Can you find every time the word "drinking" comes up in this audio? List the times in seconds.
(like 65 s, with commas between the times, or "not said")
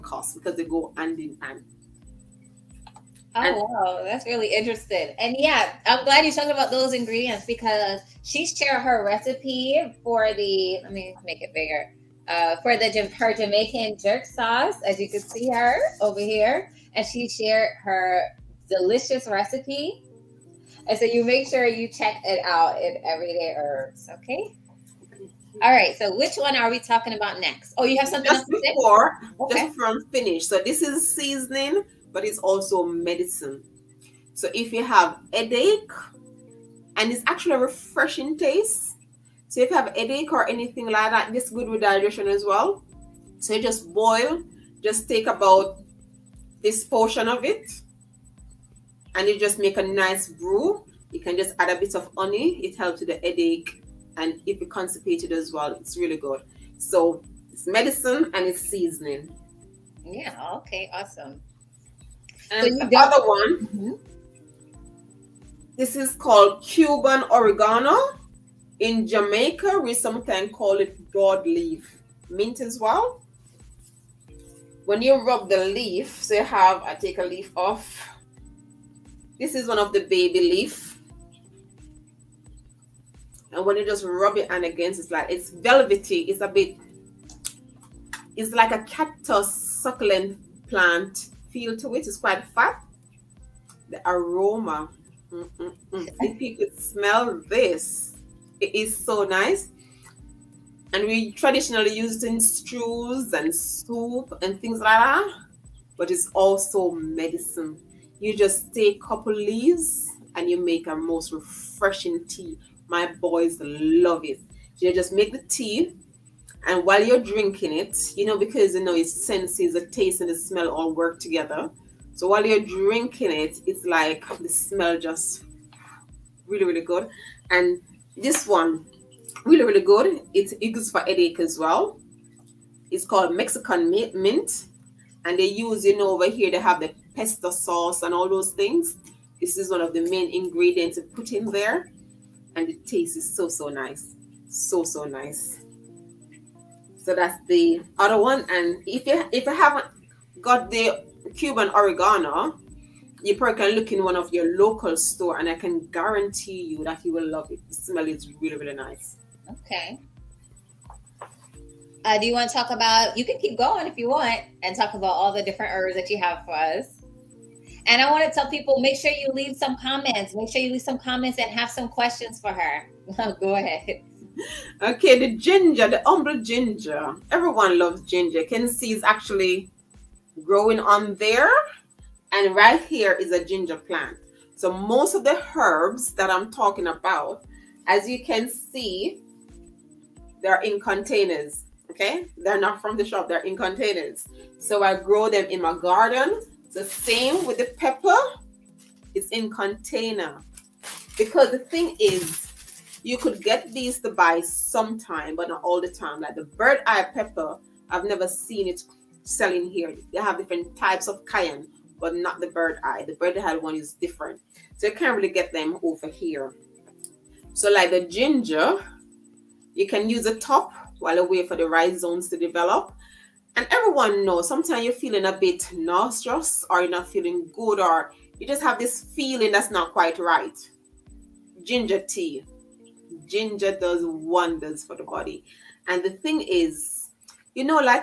117 s, 122 s.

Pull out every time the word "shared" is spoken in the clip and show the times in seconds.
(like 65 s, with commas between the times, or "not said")
8 s, 17 s.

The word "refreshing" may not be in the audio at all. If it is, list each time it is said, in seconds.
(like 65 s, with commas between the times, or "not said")
37 s, 111 s.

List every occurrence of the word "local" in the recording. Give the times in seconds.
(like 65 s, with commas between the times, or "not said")
154 s.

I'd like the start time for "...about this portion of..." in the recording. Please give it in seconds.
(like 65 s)
45 s.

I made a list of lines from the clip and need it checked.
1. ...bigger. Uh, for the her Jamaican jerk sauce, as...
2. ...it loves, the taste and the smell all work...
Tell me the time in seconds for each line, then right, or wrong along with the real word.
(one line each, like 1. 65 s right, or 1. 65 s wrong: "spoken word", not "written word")
1. 11 s right
2. 118 s wrong: "senses", not "loves".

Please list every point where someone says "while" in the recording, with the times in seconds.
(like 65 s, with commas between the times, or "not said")
116 s, 122 s, 220 s.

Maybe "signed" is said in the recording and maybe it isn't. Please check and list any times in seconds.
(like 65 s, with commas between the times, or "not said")
not said.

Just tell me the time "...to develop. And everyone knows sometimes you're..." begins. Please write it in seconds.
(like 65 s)
222 s.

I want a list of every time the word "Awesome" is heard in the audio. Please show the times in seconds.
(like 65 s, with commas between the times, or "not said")
60 s.